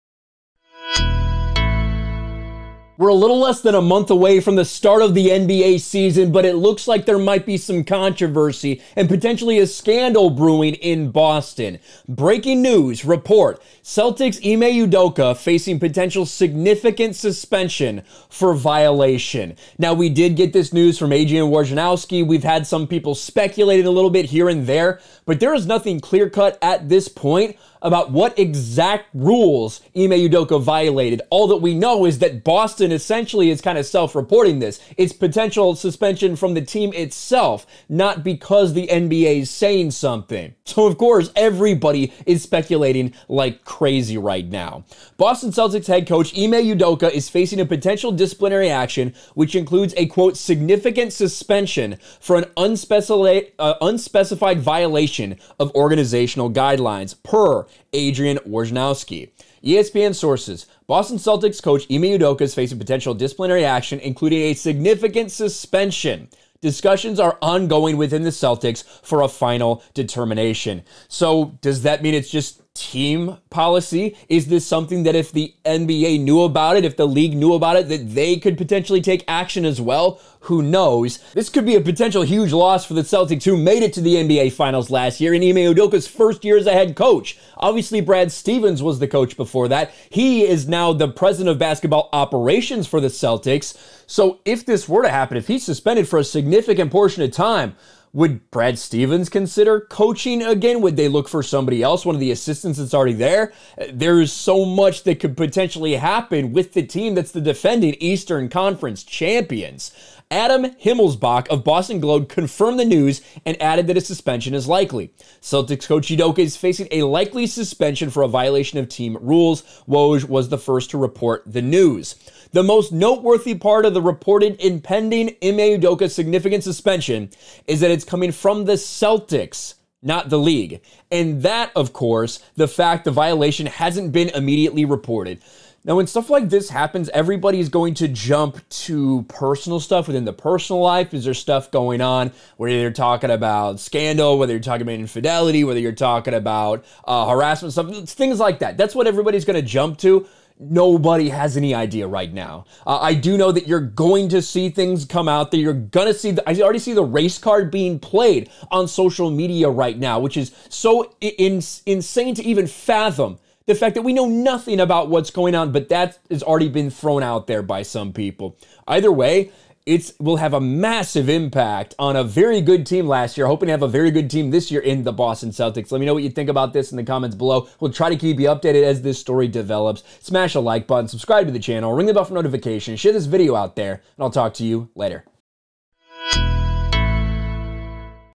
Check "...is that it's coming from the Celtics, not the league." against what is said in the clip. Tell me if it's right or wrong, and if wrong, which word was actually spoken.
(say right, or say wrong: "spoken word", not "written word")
right.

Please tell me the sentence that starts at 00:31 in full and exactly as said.
All that we know is that Boston essentially is kind of self reporting this.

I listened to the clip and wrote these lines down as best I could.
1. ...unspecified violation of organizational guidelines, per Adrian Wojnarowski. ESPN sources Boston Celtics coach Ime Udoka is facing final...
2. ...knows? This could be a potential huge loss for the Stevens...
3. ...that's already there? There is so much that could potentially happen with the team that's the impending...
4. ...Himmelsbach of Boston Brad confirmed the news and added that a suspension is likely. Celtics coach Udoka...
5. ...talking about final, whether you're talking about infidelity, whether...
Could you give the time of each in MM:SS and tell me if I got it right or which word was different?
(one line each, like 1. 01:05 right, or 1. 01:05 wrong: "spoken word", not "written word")
1. 00:53 wrong: "potential", not "final"
2. 01:20 wrong: "Celtics", not "Stevens"
3. 01:42 wrong: "defending", not "impending"
4. 01:50 wrong: "Globe", not "Brad"
5. 02:22 wrong: "scandal", not "final".